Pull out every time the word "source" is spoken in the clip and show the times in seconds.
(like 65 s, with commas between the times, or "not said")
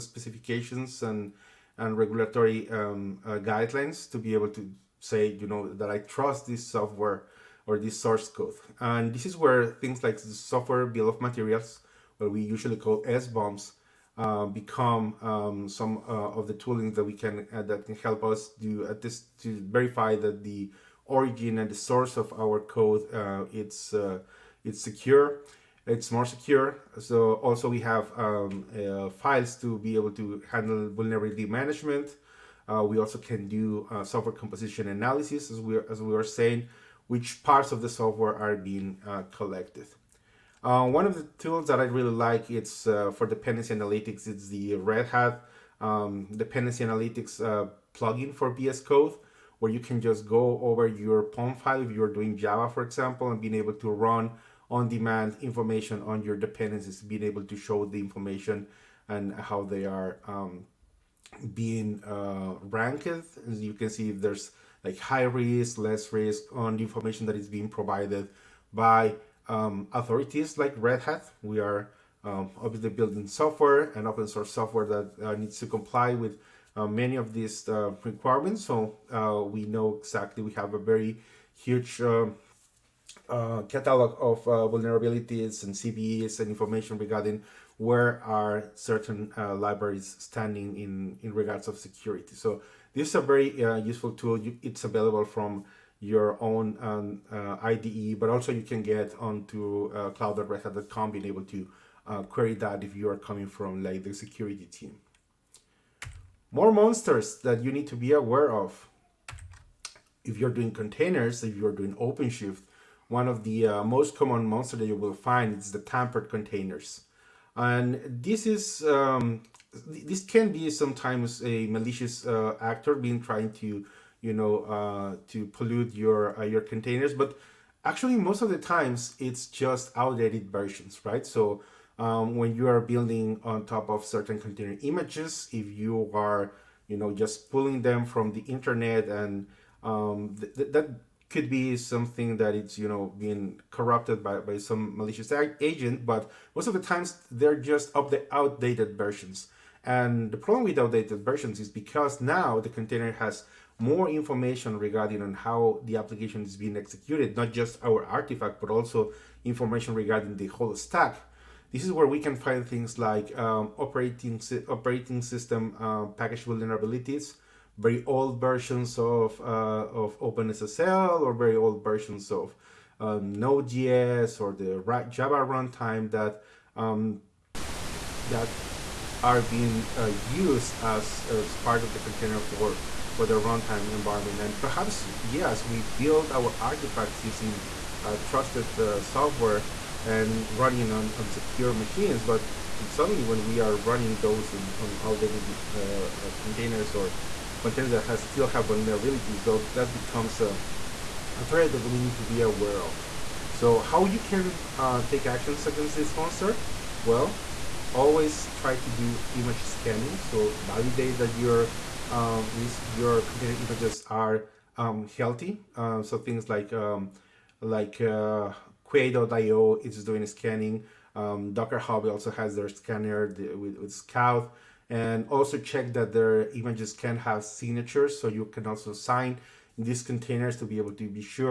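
7 s, 21 s, 74 s.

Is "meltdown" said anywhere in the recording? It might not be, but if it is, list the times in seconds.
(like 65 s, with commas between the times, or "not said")
not said.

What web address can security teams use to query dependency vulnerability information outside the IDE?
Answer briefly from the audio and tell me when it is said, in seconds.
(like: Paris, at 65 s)
cloud.redhat.com, at 100 s.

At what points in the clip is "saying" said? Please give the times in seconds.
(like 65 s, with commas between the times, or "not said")
36 s.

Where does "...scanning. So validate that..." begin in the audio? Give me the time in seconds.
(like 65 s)
209 s.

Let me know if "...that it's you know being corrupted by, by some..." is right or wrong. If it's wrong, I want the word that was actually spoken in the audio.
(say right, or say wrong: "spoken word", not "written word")
right.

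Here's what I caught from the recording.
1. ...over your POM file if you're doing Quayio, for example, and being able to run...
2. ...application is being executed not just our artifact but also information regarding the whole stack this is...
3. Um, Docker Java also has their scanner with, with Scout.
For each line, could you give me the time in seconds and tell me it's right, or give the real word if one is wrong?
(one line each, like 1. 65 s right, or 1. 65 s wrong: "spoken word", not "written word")
1. 50 s wrong: "Java", not "Quayio"
2. 155 s right
3. 221 s wrong: "Hub", not "Java".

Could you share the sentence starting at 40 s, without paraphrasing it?
Uh, one of the tools that I really like it's uh, for dependency analytics.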